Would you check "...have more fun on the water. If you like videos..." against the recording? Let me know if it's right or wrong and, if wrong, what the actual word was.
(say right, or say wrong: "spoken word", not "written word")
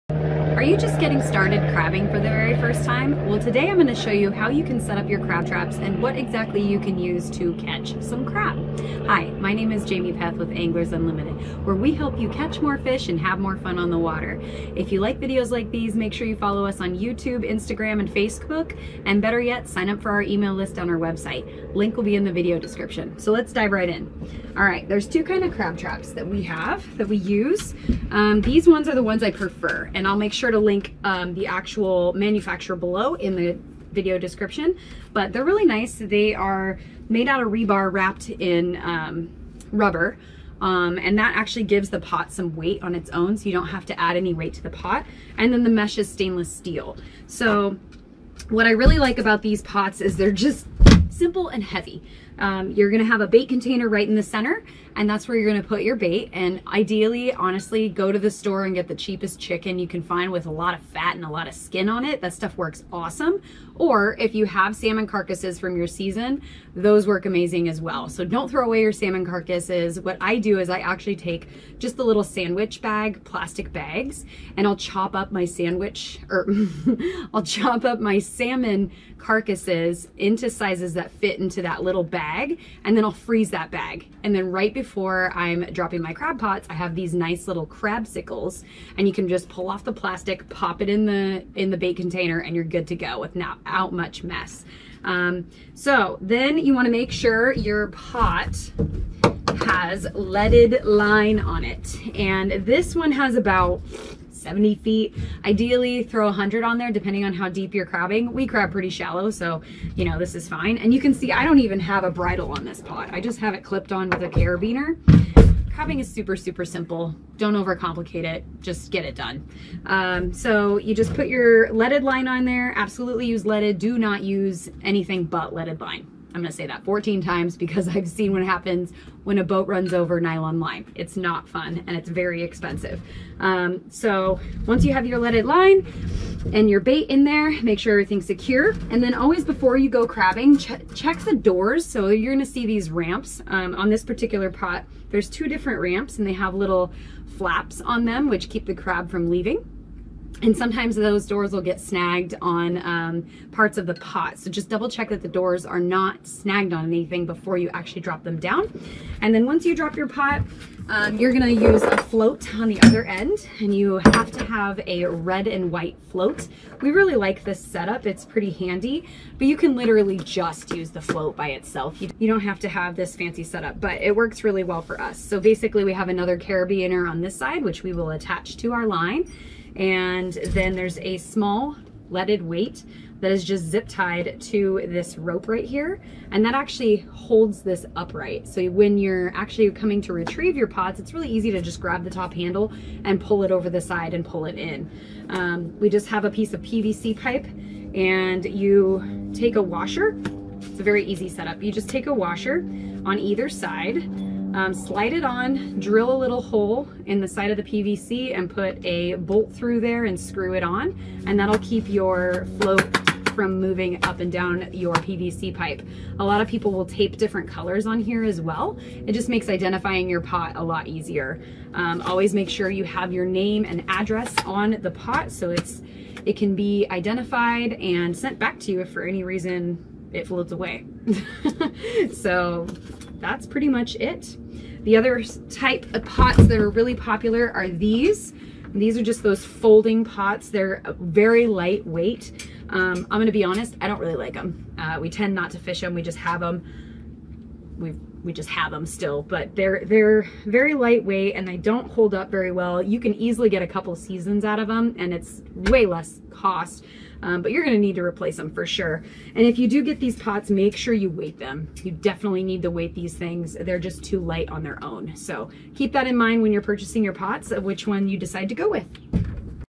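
right.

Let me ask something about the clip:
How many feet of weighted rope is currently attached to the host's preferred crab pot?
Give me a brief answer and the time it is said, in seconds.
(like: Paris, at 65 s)
70, at 104 s.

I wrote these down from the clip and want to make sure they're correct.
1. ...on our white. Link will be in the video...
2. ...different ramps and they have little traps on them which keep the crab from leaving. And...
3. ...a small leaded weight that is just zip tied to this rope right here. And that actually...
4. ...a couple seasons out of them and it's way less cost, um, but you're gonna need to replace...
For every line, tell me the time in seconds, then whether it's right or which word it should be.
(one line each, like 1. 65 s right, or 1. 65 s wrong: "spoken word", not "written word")
1. 20 s wrong: "website", not "white"
2. 145 s wrong: "flaps", not "traps"
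3. 180 s right
4. 253 s right.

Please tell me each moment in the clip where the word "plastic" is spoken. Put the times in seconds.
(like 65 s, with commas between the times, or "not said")
73 s, 89 s.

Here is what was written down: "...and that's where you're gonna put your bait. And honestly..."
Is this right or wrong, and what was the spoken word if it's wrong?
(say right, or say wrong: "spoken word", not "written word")
wrong: "ideally", not "honestly".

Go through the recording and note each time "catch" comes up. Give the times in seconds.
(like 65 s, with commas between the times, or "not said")
7 s, 12 s.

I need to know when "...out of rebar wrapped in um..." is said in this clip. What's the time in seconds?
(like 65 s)
37 s.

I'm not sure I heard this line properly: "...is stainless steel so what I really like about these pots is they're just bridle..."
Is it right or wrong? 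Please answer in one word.
wrong.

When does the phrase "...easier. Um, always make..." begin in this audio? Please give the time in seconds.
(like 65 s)
220 s.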